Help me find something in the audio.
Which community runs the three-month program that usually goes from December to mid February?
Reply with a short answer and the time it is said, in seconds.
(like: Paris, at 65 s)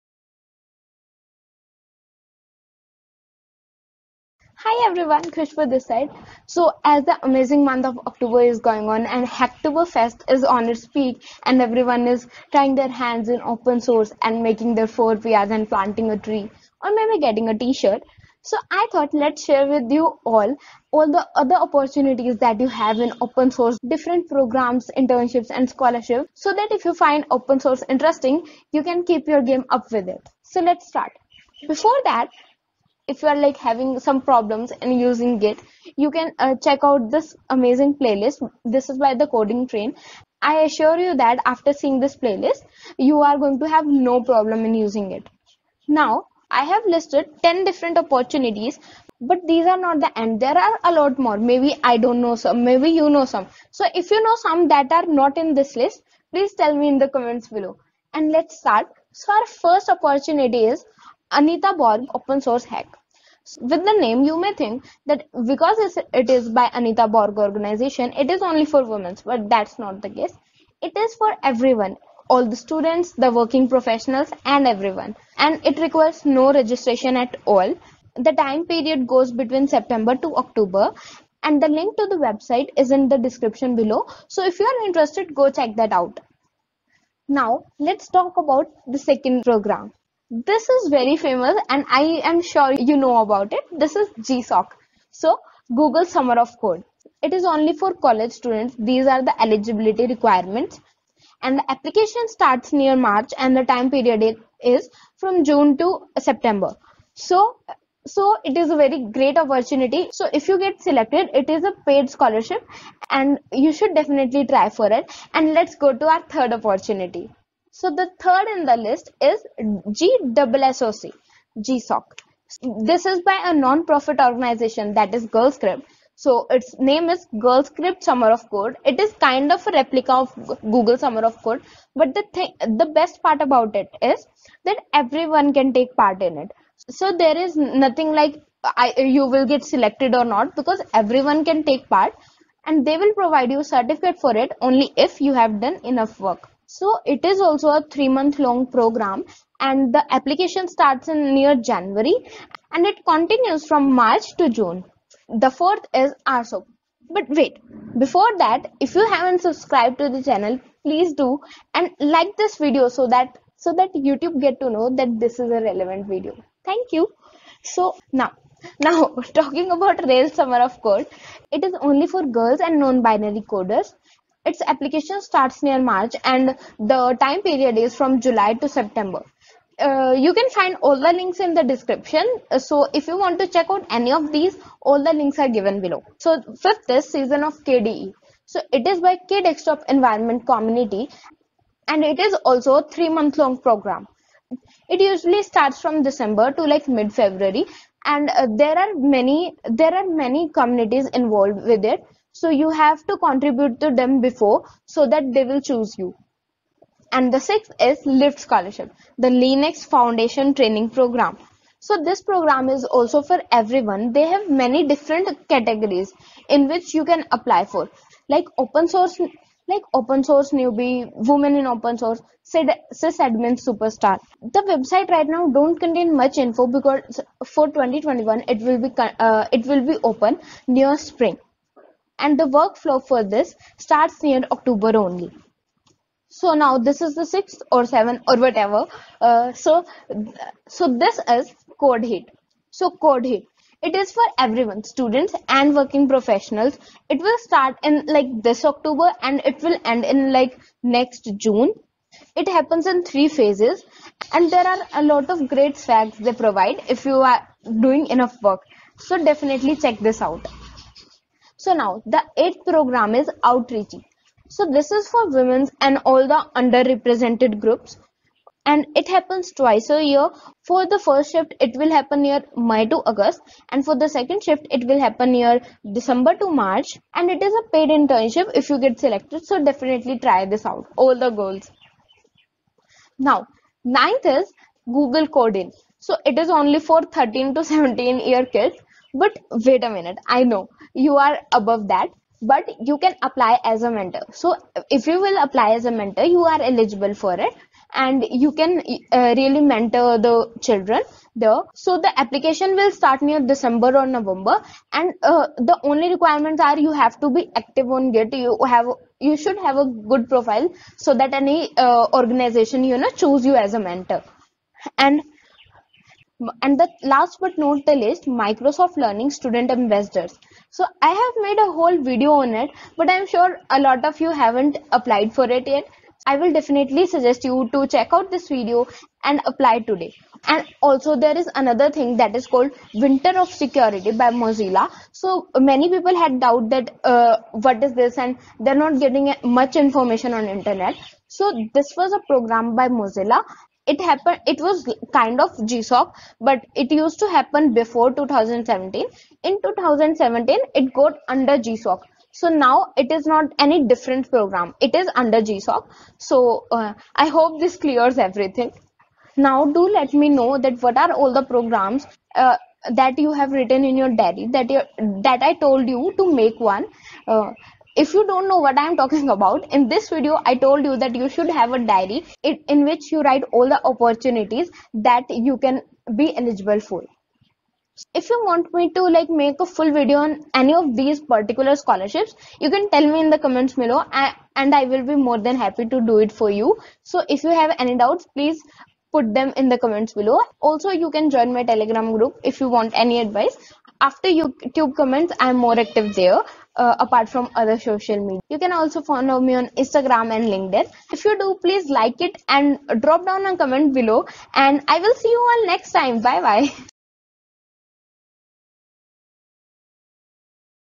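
K Desktop Environment Community, at 189 s.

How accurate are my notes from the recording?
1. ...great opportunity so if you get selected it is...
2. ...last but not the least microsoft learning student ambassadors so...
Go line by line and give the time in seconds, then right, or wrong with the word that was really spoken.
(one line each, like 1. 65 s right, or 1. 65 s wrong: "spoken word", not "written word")
1. 109 s right
2. 317 s right.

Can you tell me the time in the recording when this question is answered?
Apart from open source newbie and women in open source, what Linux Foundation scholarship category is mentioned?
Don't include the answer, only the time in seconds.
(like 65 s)
222 s.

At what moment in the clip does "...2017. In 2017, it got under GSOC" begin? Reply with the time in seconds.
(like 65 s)
348 s.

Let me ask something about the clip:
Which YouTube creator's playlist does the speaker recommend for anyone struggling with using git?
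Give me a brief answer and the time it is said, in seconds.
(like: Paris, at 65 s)
The Coding Train, at 39 s.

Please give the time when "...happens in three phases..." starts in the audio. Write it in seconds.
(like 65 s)
252 s.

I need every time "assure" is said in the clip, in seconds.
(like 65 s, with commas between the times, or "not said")
40 s.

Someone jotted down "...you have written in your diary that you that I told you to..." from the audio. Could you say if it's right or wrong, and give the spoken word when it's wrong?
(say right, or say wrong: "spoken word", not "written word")
right.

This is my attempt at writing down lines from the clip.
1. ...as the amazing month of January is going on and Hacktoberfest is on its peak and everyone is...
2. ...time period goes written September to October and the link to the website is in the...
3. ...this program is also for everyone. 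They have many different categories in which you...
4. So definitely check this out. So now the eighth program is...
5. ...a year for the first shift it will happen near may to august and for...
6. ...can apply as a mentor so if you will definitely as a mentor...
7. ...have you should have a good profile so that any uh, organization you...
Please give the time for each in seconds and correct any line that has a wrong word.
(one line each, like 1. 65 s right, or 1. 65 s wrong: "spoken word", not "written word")
1. 6 s wrong: "October", not "January"
2. 78 s wrong: "between", not "written"
3. 212 s right
4. 258 s right
5. 269 s right
6. 292 s wrong: "apply", not "definitely"
7. 308 s right.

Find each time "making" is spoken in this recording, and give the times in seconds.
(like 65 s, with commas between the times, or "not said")
14 s.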